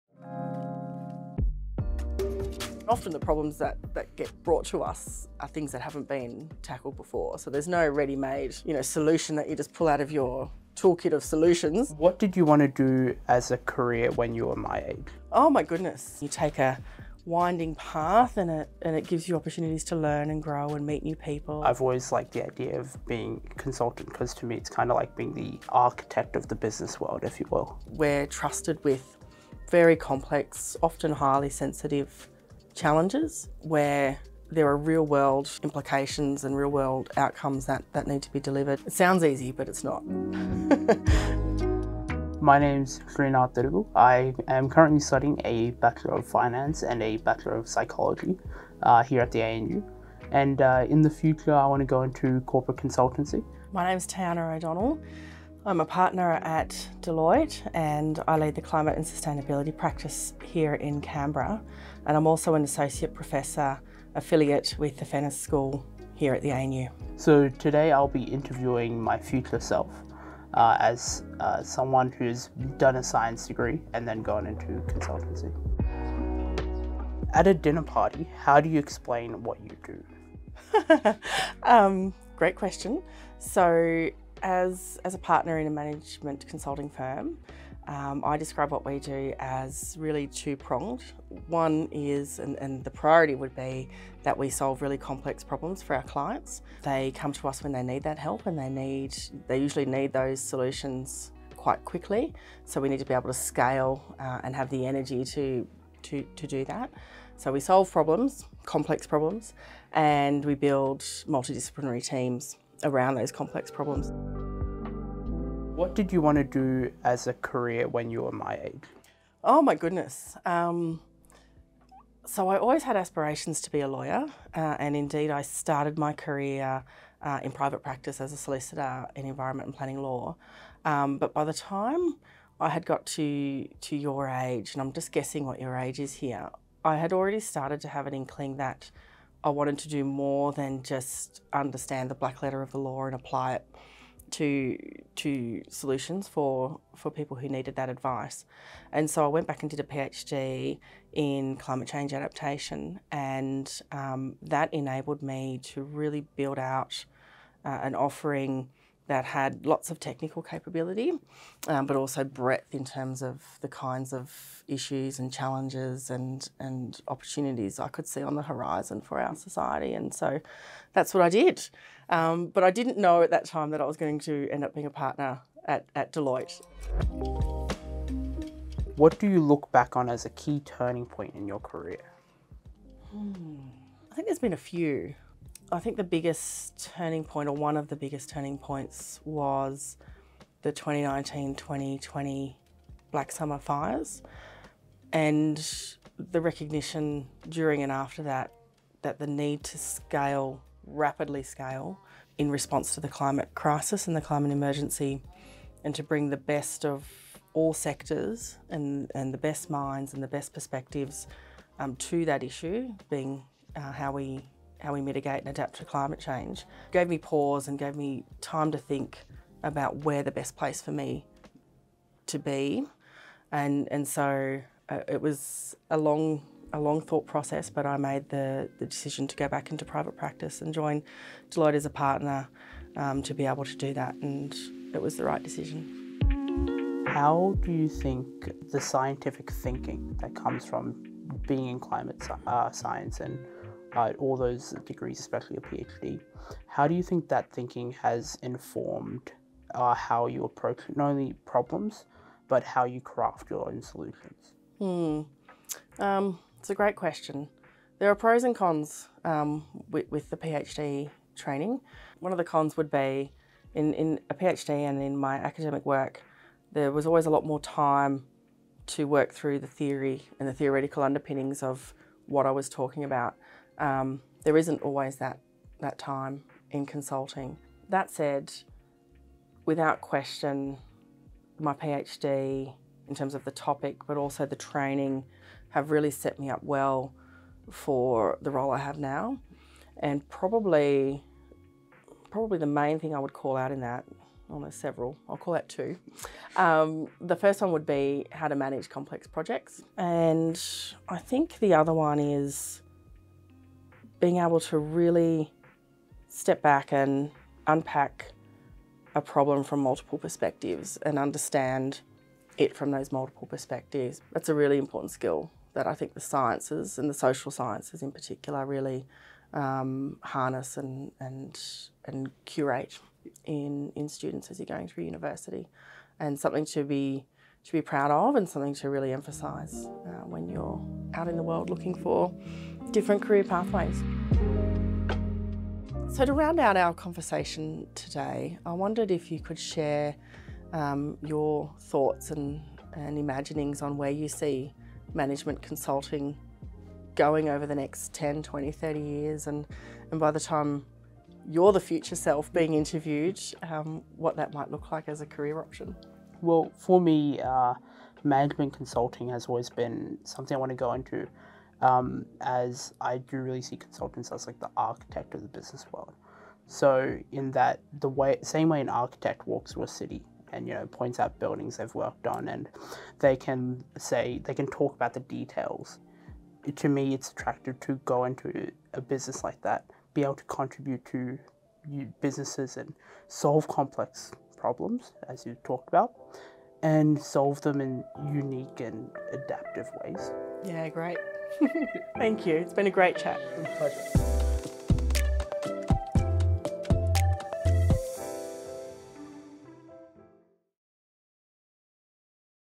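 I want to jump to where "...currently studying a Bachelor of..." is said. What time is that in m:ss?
0:44.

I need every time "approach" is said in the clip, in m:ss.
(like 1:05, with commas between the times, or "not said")
4:10.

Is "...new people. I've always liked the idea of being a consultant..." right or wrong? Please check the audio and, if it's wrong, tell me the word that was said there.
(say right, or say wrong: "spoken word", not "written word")
right.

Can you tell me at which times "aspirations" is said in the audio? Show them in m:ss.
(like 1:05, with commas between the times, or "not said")
2:02.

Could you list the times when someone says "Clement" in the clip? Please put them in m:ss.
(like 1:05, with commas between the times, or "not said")
not said.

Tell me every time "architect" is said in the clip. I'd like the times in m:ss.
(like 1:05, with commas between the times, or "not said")
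0:25, 6:04, 6:08.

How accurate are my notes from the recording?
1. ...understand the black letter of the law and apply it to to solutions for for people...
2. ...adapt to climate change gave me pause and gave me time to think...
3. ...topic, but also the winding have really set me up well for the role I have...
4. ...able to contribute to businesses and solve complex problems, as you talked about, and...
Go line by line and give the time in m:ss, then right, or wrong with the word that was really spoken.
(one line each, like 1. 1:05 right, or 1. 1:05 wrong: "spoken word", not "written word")
1. 2:21 right
2. 3:35 right
3. 4:43 wrong: "training", not "winding"
4. 6:20 right.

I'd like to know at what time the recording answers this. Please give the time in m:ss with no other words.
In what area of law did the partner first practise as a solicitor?
2:09.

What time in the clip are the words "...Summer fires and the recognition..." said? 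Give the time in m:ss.
3:13.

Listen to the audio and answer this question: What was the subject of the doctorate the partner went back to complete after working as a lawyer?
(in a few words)
Climate change adaptation.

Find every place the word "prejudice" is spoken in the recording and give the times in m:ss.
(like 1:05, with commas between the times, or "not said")
not said.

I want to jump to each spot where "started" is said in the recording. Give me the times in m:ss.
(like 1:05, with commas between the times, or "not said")
2:05, 2:17.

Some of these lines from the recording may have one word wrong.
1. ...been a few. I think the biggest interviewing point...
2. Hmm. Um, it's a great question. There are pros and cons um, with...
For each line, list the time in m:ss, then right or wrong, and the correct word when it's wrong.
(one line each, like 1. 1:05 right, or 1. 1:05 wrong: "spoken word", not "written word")
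1. 3:04 wrong: "turning", not "interviewing"
2. 4:14 right.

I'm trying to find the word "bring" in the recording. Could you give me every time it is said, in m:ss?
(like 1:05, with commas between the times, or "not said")
3:26.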